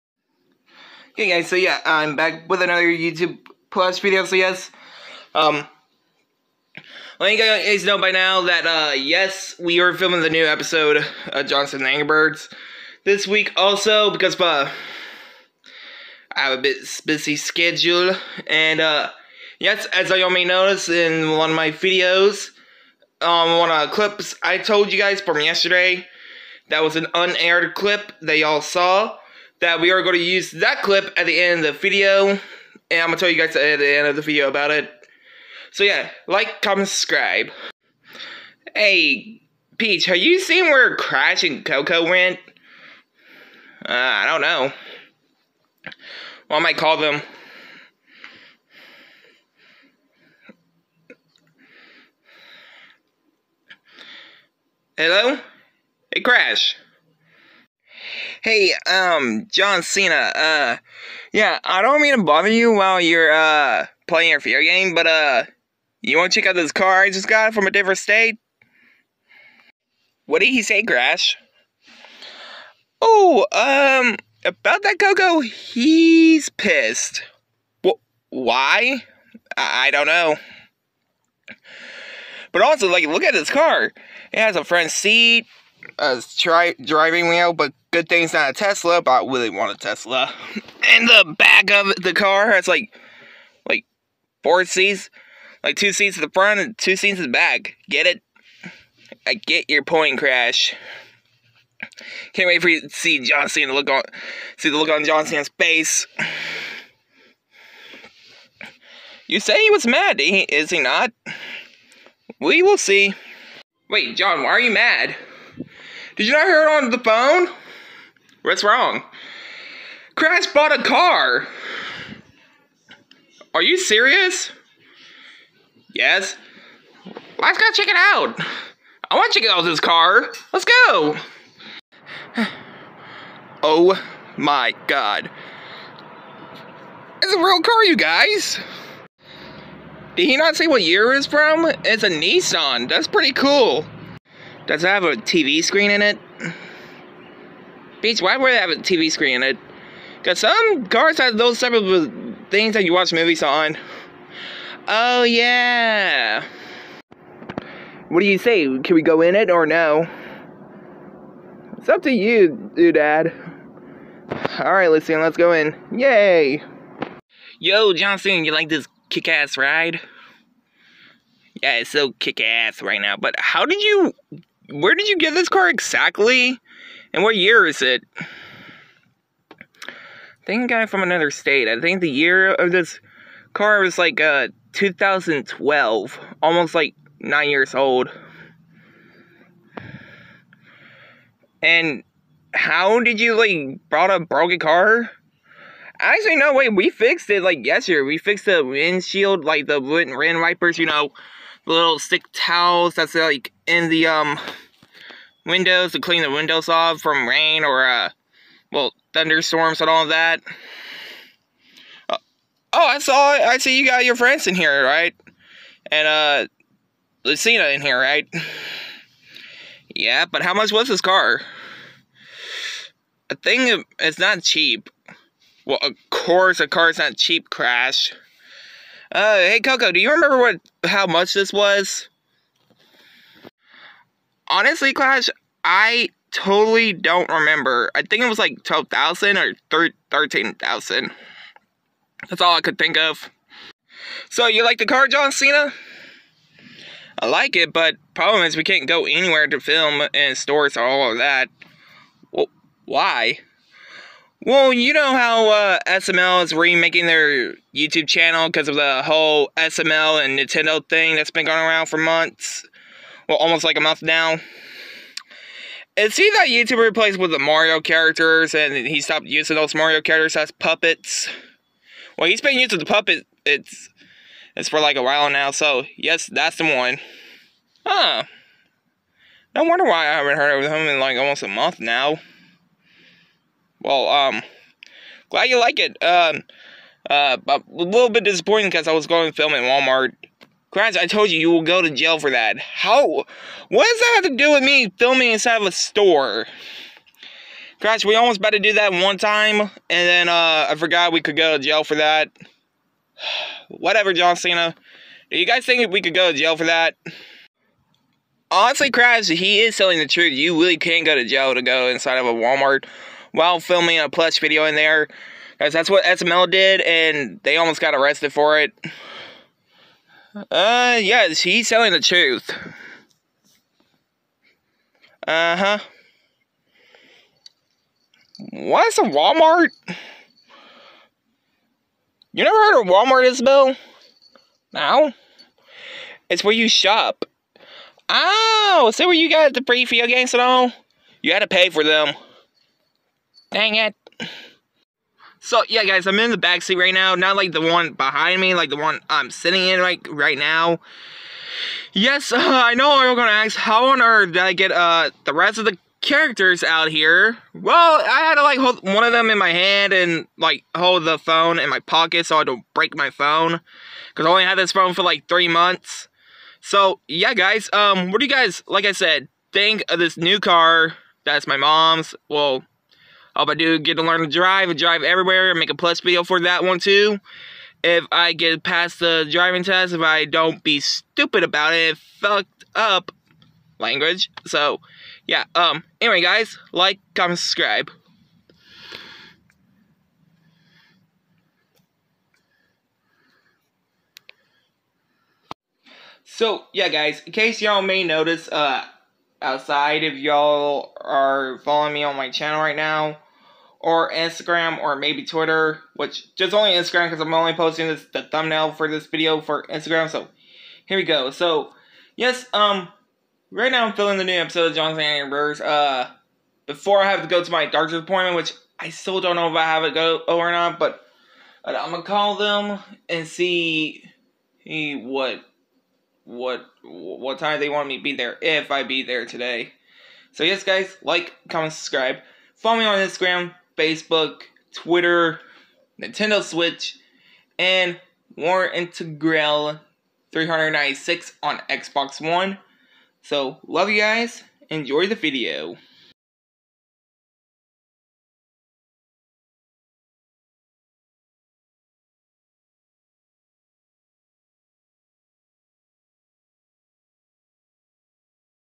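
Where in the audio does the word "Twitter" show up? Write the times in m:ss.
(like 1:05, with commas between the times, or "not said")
6:45, 7:14.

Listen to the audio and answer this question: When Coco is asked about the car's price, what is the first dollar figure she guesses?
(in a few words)
12,000.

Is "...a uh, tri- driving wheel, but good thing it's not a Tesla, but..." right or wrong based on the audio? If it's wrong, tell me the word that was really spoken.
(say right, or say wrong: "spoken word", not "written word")
right.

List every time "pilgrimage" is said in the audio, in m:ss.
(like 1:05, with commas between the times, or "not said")
not said.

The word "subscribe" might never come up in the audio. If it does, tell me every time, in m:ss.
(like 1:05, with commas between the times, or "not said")
0:36, 6:27, 7:11.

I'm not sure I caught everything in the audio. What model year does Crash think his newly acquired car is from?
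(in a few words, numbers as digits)
2012.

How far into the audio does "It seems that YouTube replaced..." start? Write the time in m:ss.
4:25.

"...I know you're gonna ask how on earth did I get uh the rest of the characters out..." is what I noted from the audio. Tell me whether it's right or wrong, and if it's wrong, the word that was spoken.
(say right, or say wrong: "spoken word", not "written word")
right.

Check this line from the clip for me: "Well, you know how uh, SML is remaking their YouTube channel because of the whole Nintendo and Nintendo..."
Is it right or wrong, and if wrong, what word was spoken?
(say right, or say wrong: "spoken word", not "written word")
wrong: "SML", not "Nintendo".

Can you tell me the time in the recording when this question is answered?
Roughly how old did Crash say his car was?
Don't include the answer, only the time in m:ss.
3:07.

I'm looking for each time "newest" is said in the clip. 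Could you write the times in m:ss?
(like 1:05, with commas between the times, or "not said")
not said.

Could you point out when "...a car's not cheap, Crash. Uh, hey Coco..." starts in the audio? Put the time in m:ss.
3:46.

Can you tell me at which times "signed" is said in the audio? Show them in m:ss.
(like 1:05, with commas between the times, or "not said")
not said.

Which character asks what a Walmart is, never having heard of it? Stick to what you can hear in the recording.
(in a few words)
Isabel.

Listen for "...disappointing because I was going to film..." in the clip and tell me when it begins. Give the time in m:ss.
4:48.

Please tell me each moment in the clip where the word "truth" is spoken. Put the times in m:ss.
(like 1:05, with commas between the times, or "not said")
5:10, 5:21.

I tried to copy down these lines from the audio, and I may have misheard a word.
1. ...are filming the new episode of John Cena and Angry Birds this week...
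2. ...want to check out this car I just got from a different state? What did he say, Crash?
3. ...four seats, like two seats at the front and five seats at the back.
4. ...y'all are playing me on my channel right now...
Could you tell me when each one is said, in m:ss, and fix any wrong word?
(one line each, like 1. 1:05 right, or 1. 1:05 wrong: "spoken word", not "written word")
1. 0:09 right
2. 1:06 right
3. 1:34 wrong: "two", not "five"
4. 6:40 wrong: "following", not "playing".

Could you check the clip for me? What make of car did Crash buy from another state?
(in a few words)
Nissan.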